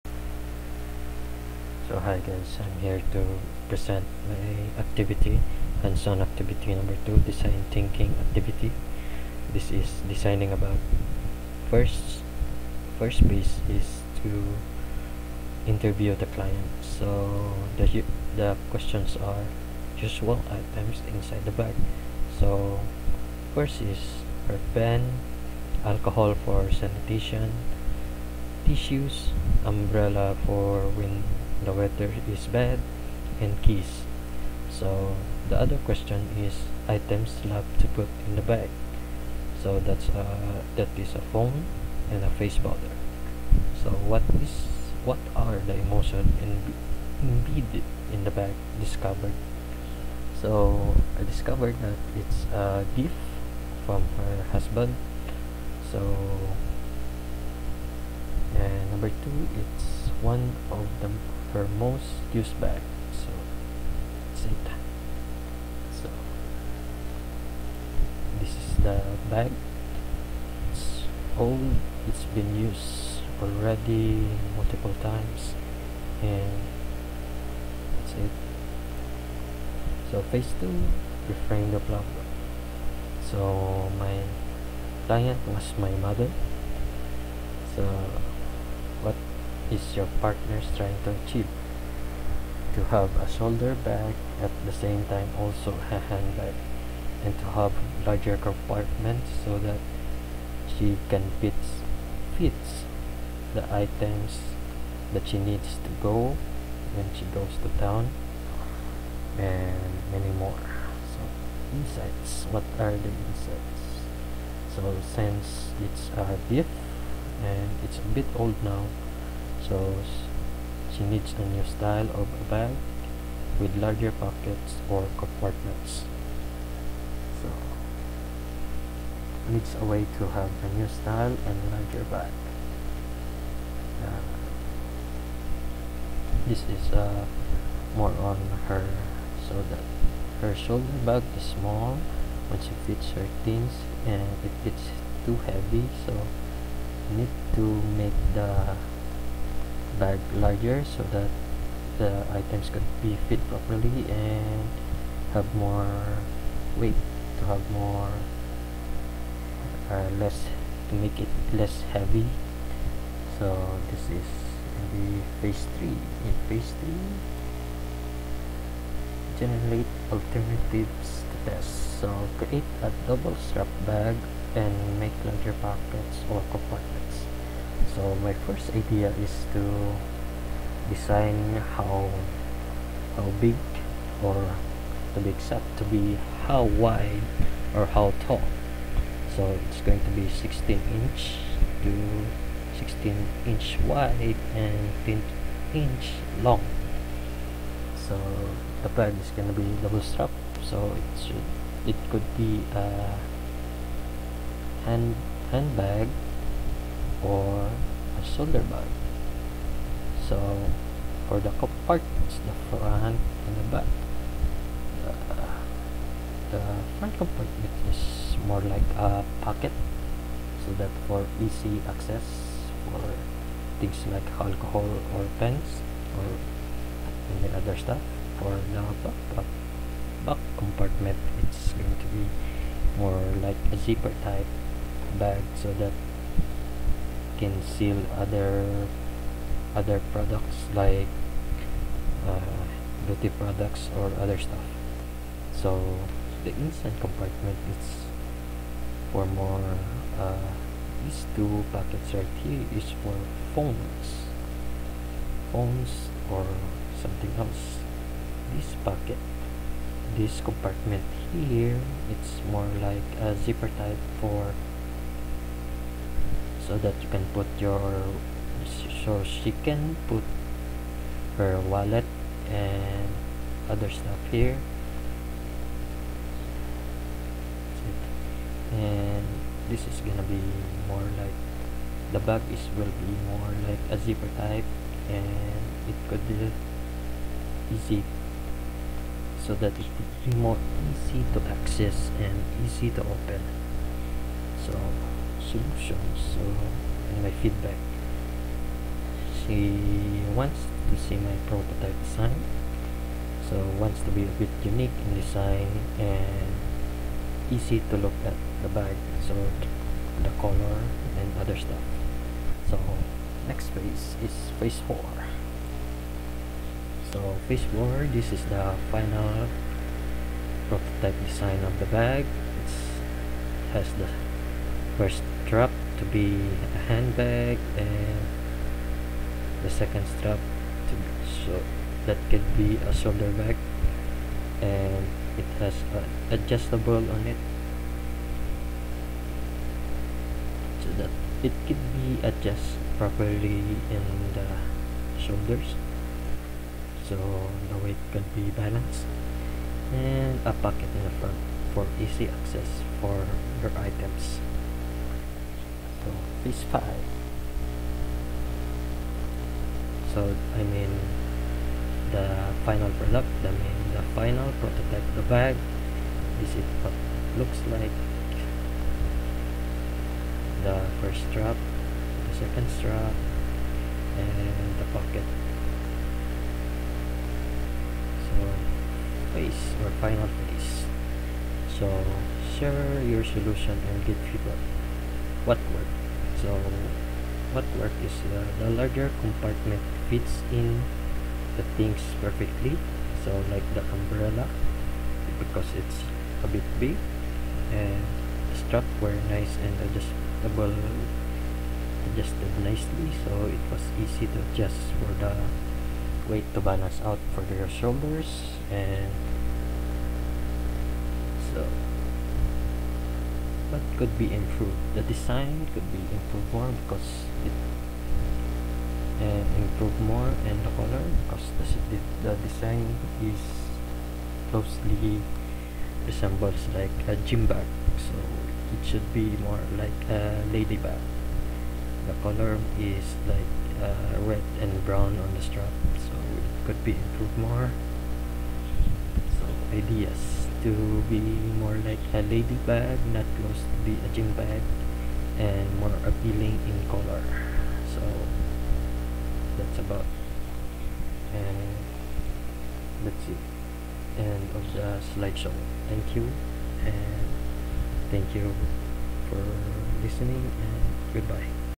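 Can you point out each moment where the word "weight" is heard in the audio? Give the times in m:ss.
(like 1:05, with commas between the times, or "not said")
2:36, 5:47, 6:46.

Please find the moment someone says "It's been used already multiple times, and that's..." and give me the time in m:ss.
1:12.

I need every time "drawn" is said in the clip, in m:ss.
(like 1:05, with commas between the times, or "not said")
not said.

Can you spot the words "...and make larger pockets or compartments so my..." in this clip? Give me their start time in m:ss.
2:54.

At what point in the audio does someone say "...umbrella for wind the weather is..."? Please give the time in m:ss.
0:29.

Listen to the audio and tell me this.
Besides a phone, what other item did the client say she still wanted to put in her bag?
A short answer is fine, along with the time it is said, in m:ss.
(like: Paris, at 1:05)
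Face powder, at 0:42.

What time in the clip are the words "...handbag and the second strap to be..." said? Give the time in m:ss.
5:26.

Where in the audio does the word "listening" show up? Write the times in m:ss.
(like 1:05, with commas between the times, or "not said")
7:40.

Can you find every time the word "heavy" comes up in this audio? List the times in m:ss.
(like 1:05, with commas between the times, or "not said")
2:25, 2:41.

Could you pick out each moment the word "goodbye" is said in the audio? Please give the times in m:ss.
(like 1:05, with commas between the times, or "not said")
7:41.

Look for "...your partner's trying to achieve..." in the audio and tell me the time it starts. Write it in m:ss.
1:29.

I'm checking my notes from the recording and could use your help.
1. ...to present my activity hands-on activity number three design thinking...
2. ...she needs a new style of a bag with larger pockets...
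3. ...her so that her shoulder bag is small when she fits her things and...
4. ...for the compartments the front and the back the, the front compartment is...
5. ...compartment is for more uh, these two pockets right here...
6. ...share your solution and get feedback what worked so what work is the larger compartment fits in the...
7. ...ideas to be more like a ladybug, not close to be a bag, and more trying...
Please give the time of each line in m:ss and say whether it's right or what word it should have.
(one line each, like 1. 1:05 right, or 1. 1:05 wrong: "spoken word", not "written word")
1. 0:03 wrong: "two", not "three"
2. 2:00 right
3. 2:18 right
4. 3:31 right
5. 4:07 right
6. 6:22 right
7. 7:19 wrong: "appealing", not "trying".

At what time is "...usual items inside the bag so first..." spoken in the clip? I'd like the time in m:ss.
0:19.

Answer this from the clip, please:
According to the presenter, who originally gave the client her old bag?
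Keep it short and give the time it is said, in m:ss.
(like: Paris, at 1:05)
Her husband, at 0:54.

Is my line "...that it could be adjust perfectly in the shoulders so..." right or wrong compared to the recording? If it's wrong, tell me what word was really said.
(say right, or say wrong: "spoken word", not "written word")
wrong: "properly", not "perfectly".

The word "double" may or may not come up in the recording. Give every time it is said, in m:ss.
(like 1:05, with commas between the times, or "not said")
2:53, 3:19.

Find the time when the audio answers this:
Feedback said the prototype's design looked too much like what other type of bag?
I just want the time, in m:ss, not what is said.
7:07.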